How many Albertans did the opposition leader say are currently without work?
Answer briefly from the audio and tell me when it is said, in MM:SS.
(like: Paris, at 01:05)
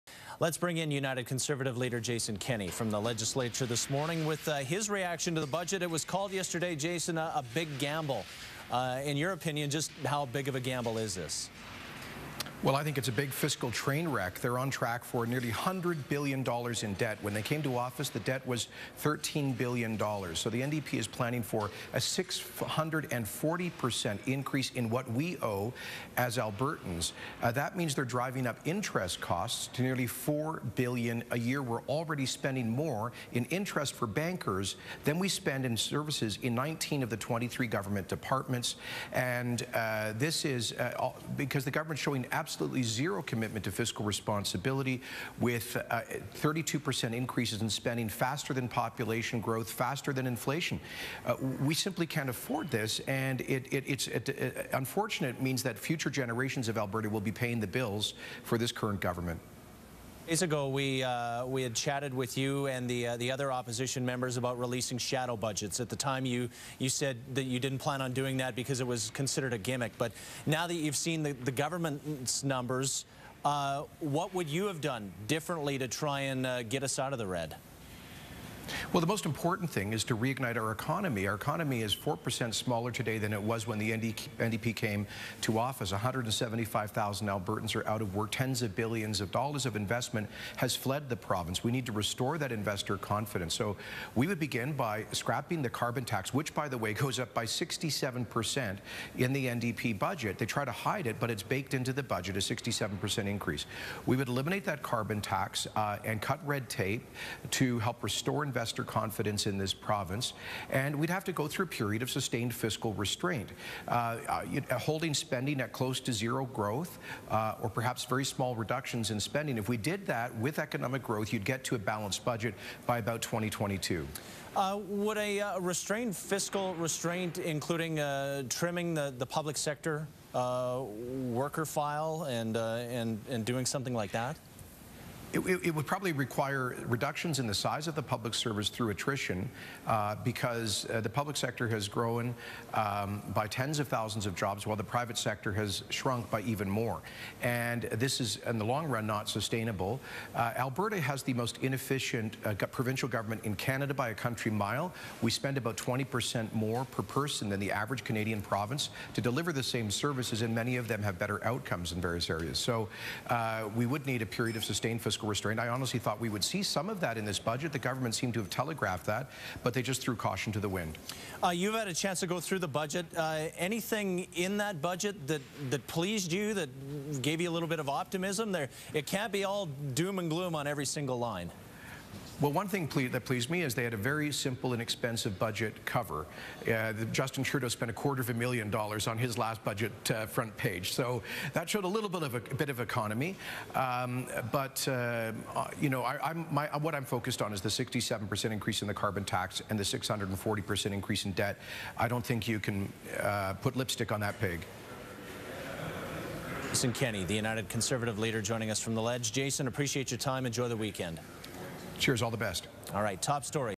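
175,000, at 01:25.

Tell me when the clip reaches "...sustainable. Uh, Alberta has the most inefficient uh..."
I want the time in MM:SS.
02:29.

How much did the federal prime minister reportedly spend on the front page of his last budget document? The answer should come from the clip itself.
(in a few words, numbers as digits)
A quarter of a million dollars.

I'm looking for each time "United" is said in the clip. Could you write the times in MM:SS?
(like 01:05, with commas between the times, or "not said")
00:00, 03:27.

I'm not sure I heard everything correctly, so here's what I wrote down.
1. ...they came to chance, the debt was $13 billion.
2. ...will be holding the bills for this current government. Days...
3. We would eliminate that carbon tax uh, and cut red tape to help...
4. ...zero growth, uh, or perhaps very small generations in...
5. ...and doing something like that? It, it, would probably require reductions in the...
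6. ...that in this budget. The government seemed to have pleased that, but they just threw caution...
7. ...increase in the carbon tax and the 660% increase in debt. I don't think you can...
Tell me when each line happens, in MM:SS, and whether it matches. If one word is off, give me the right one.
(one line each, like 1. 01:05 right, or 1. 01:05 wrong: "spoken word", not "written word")
1. 00:17 wrong: "office", not "chance"
2. 00:57 wrong: "paying", not "holding"
3. 01:44 right
4. 01:56 wrong: "reductions", not "generations"
5. 02:13 right
6. 02:47 wrong: "telegraphed", not "pleased"
7. 03:18 wrong: "640", not "660".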